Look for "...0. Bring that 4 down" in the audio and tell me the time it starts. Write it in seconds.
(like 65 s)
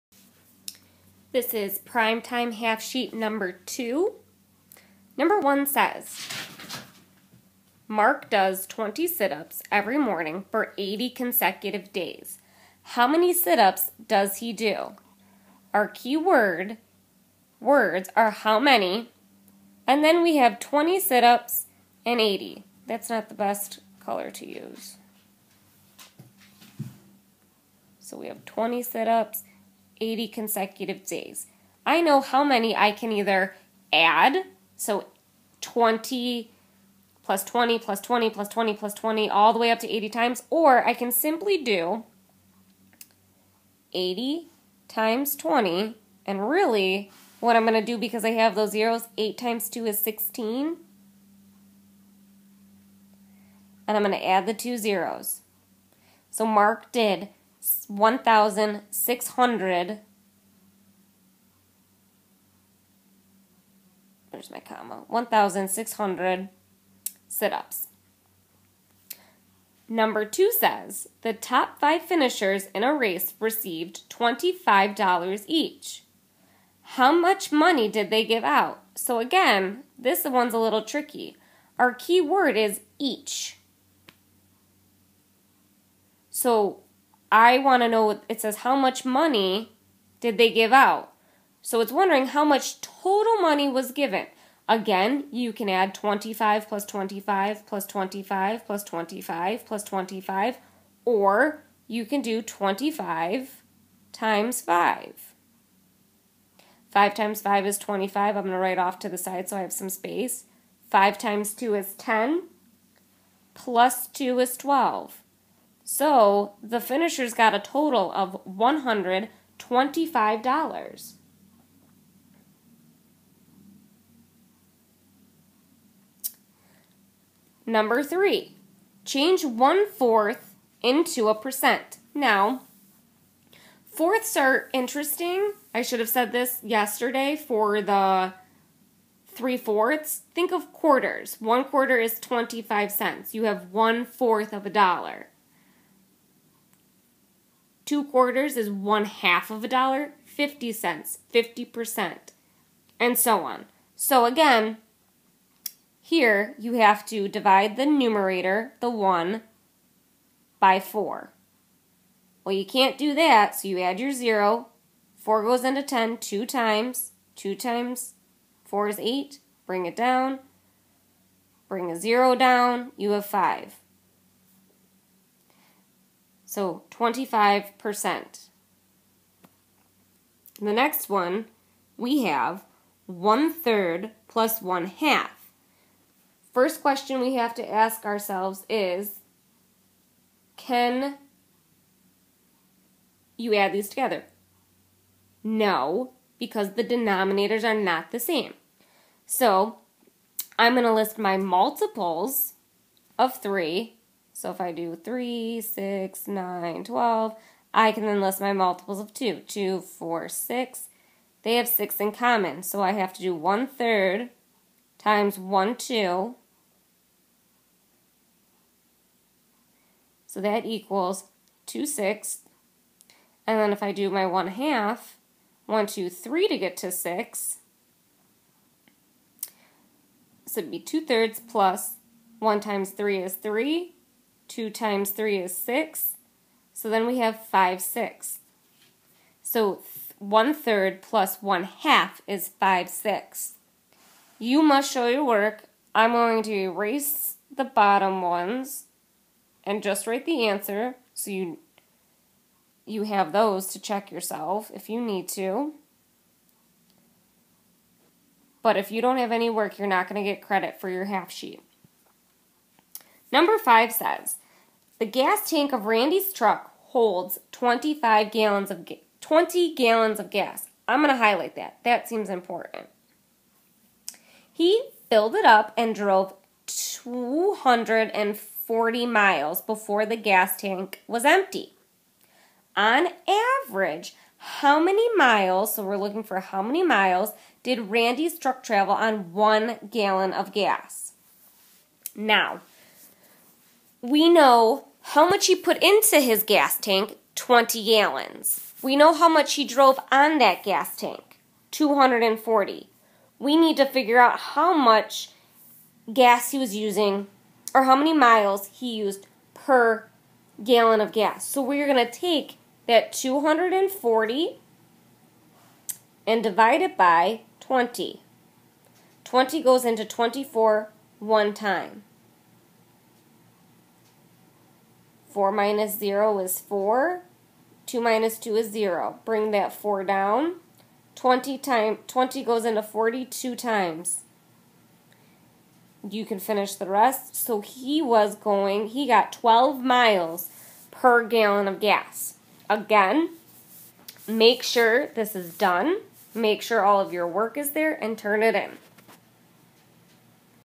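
328 s.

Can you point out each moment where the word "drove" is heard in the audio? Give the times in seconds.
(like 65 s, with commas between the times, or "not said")
275 s, 299 s.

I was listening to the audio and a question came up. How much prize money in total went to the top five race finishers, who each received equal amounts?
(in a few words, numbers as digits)
$125.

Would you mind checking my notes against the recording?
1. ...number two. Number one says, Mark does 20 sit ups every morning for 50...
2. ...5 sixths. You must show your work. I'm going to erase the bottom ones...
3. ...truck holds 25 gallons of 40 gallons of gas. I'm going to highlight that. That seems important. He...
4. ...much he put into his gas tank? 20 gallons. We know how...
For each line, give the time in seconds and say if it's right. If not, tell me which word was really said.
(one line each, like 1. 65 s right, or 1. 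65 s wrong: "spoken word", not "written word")
1. 3 s wrong: "80", not "50"
2. 242 s right
3. 266 s wrong: "20", not "40"
4. 295 s right.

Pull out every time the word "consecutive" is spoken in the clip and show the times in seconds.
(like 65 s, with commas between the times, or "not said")
11 s, 30 s.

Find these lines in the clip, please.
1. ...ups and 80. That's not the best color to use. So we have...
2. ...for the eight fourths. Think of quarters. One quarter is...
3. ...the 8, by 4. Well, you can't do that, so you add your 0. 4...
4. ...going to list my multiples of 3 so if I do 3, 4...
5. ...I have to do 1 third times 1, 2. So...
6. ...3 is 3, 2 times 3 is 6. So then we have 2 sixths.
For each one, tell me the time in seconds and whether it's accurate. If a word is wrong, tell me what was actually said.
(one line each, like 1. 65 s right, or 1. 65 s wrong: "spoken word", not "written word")
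1. 21 s right
2. 137 s wrong: "three", not "eight"
3. 158 s wrong: "1", not "8"
4. 200 s wrong: "6", not "4"
5. 212 s right
6. 232 s wrong: "5", not "2".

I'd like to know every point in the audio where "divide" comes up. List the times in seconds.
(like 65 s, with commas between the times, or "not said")
157 s, 316 s.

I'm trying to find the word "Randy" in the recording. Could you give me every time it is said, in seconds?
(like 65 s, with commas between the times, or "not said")
265 s, 287 s.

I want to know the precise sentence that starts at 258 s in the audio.
But if you don't have any work, you're not going to get credit for your half sheet.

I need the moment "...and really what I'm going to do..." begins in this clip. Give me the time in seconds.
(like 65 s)
46 s.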